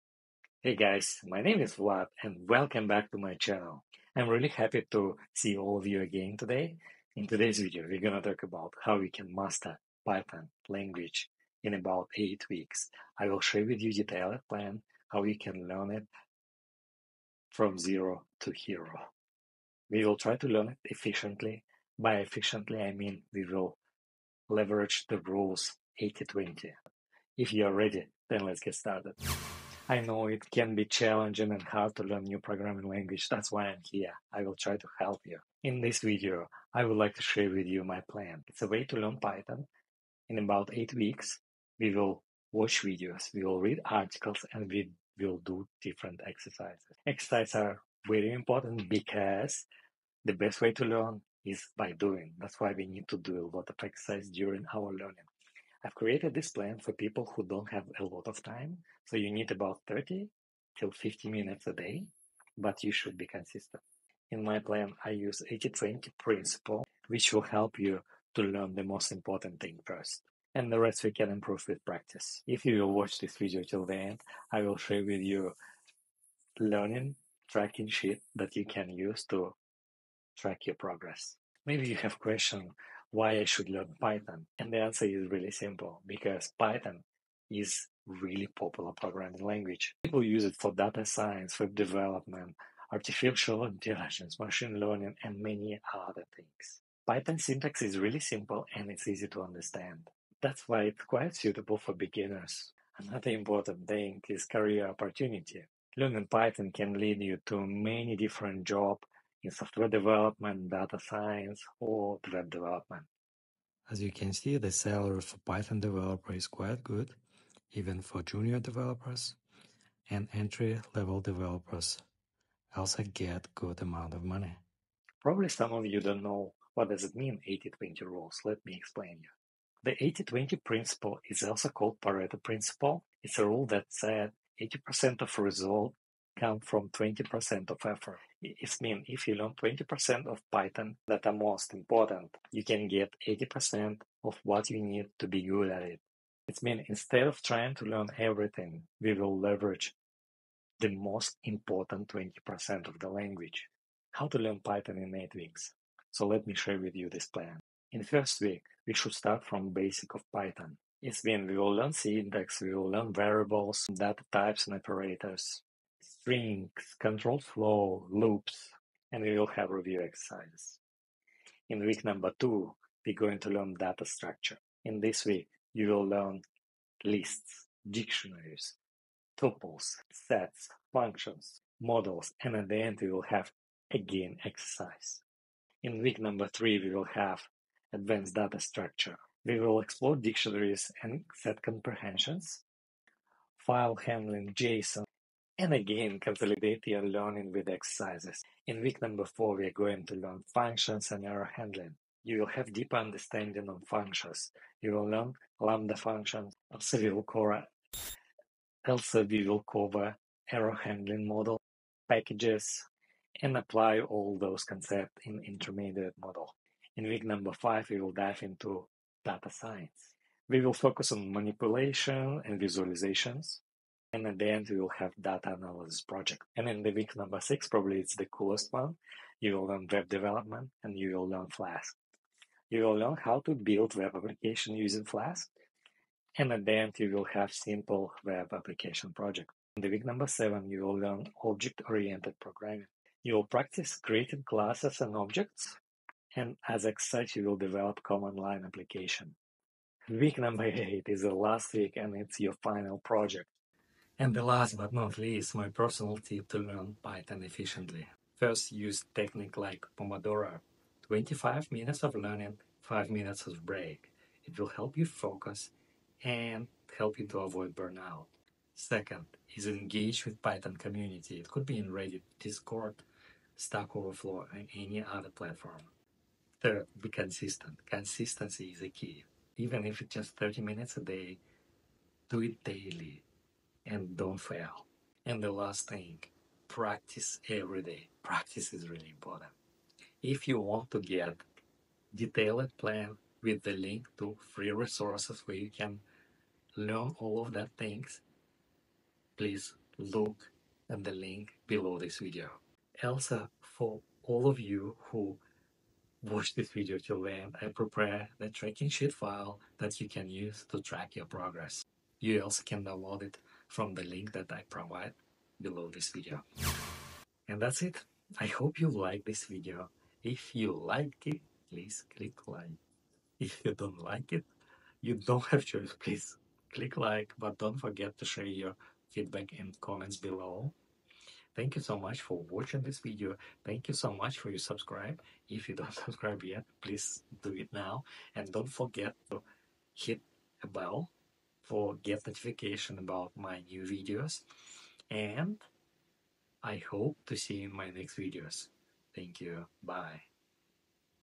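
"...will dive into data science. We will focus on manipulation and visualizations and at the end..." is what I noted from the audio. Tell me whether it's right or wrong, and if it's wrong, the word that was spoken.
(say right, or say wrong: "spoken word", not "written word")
right.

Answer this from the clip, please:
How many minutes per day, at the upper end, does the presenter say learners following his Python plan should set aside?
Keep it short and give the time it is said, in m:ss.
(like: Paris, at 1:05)
50 minutes, at 1:00.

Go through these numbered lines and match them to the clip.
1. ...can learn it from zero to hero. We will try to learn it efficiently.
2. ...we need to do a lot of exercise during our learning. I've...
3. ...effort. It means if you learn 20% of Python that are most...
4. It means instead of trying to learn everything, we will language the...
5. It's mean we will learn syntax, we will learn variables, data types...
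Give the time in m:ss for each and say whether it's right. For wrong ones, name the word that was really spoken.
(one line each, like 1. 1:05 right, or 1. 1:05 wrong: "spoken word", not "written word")
1. 0:15 right
2. 0:52 right
3. 2:17 right
4. 2:26 wrong: "leverage", not "language"
5. 2:40 right.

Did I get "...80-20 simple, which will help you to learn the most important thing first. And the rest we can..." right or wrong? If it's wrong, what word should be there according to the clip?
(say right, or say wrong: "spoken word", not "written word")
wrong: "principle", not "simple".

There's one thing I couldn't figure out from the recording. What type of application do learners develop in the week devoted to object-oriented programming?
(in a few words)
Command line application.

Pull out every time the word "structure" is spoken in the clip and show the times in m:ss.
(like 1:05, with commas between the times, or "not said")
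2:54, 3:08.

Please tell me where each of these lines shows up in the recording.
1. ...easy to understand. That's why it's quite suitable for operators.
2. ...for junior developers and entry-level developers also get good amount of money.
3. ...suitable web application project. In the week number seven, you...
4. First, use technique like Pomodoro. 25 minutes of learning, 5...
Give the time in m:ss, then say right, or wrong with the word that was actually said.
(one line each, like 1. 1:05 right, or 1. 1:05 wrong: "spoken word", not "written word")
1. 1:39 wrong: "beginners", not "operators"
2. 1:58 right
3. 3:57 wrong: "simple", not "suitable"
4. 4:18 right.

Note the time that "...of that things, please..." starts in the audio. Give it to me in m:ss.
4:57.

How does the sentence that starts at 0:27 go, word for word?
If you are ready, then let's get started.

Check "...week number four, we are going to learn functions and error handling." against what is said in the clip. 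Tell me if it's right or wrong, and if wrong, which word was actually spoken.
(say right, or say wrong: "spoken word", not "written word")
right.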